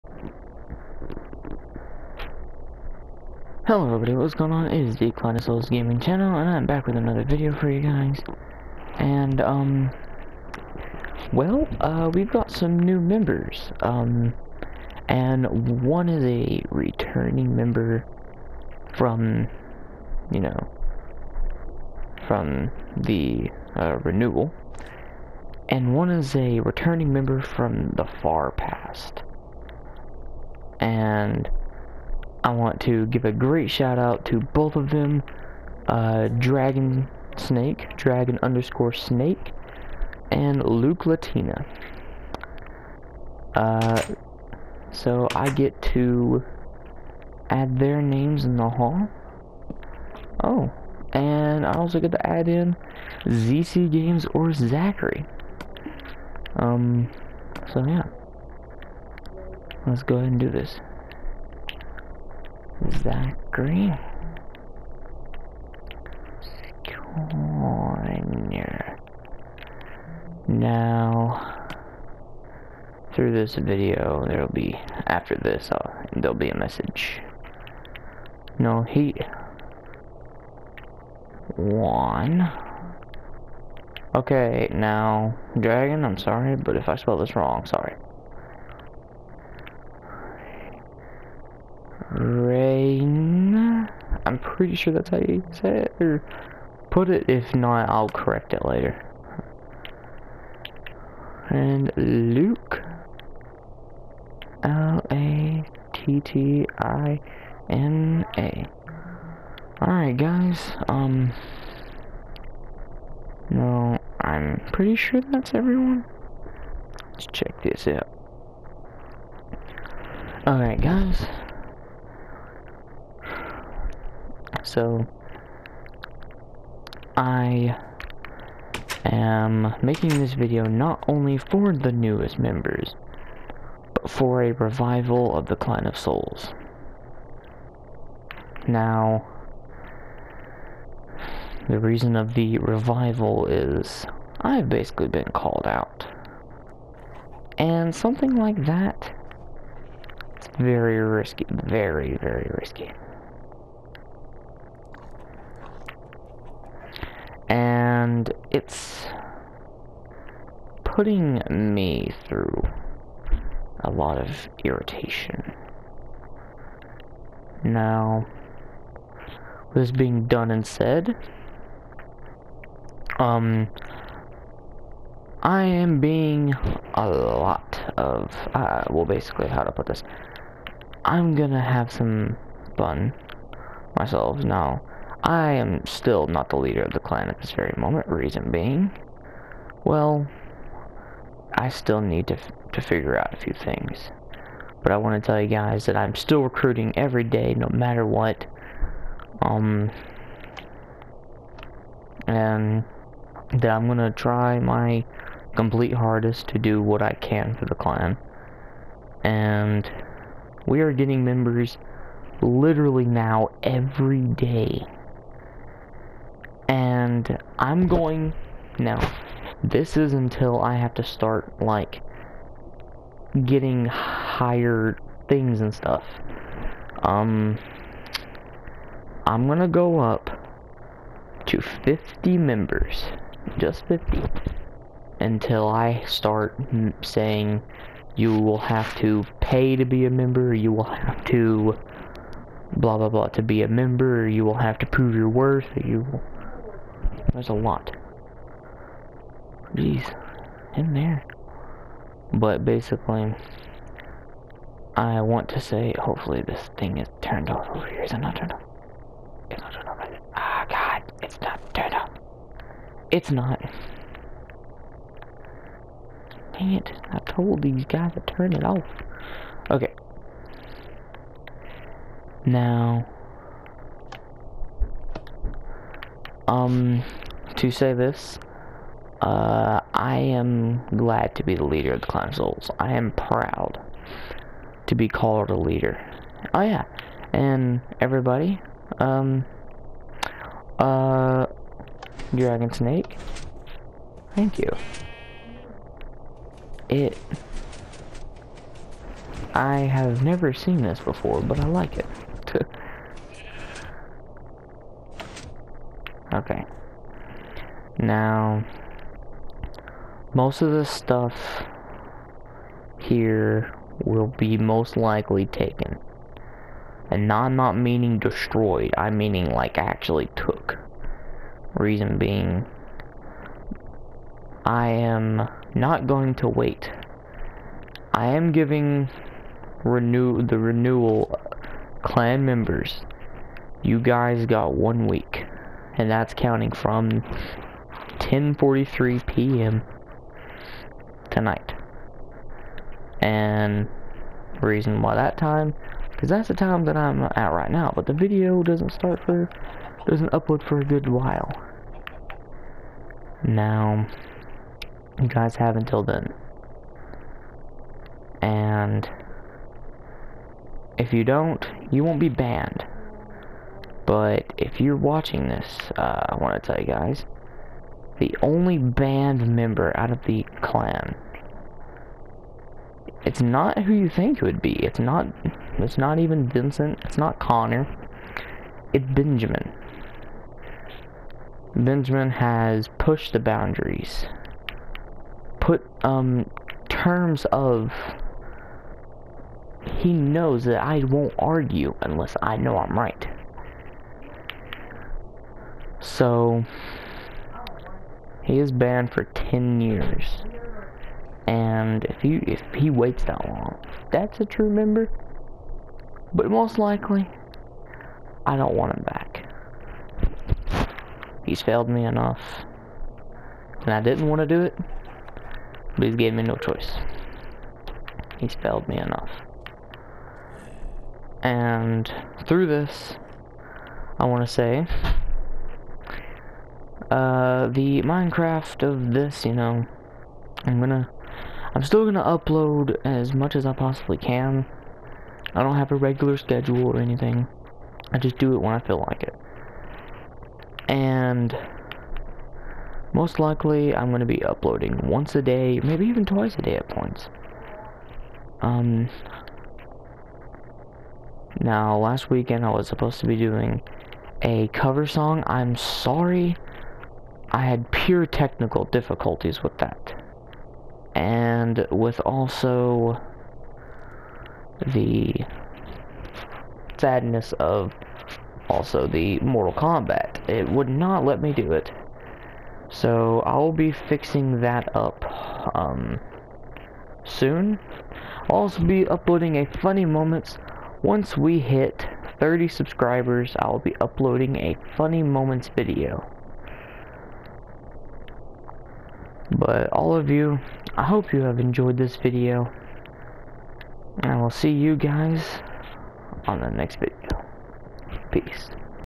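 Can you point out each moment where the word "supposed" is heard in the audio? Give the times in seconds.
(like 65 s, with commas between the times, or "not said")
452 s.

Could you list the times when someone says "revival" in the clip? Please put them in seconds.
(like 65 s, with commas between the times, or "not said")
134 s, 142 s.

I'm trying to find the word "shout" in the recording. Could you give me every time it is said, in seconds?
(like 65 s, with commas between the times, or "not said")
33 s.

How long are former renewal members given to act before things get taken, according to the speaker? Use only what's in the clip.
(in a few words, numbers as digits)
One week.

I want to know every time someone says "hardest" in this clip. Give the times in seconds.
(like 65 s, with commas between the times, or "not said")
205 s.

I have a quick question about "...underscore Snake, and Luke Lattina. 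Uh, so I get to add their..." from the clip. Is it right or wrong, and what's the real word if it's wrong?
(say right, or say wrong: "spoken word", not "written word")
right.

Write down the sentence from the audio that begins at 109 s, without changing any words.
Alright guys, um, no, I'm pretty sure that's everyone.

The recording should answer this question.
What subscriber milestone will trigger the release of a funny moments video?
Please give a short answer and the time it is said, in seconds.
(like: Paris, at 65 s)
30 subscribers, at 482 s.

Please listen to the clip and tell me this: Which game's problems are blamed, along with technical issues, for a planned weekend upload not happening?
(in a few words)
Mortal Kombat.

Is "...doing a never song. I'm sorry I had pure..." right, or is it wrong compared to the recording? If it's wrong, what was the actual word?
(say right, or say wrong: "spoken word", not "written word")
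wrong: "cover", not "never".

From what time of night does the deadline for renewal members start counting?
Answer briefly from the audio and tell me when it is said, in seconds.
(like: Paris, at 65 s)
10:43 p.m., at 338 s.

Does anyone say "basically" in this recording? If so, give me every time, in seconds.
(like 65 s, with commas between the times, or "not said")
144 s, 179 s, 252 s.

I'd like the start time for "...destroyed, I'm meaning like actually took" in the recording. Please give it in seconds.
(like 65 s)
318 s.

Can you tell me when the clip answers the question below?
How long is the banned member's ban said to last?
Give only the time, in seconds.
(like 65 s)
399 s.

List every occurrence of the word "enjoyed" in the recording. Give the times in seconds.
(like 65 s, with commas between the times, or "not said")
491 s.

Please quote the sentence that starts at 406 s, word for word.
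But most likely, I don't want him back.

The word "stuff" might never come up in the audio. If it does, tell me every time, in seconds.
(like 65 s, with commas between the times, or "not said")
225 s, 310 s.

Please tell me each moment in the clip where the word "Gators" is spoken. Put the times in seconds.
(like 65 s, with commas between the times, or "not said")
not said.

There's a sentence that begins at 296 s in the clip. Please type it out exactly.
It, I have never seen this before, but I like it.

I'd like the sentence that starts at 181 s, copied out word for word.
I'm gonna have some fun myself now.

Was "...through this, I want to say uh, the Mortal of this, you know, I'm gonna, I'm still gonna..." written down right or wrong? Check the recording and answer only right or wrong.
wrong.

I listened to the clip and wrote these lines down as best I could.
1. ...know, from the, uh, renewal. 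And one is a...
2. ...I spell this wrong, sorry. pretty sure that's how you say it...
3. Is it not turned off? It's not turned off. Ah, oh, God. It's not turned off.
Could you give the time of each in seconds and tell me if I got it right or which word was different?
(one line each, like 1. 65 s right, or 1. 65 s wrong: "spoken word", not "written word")
1. 20 s right
2. 86 s right
3. 258 s right.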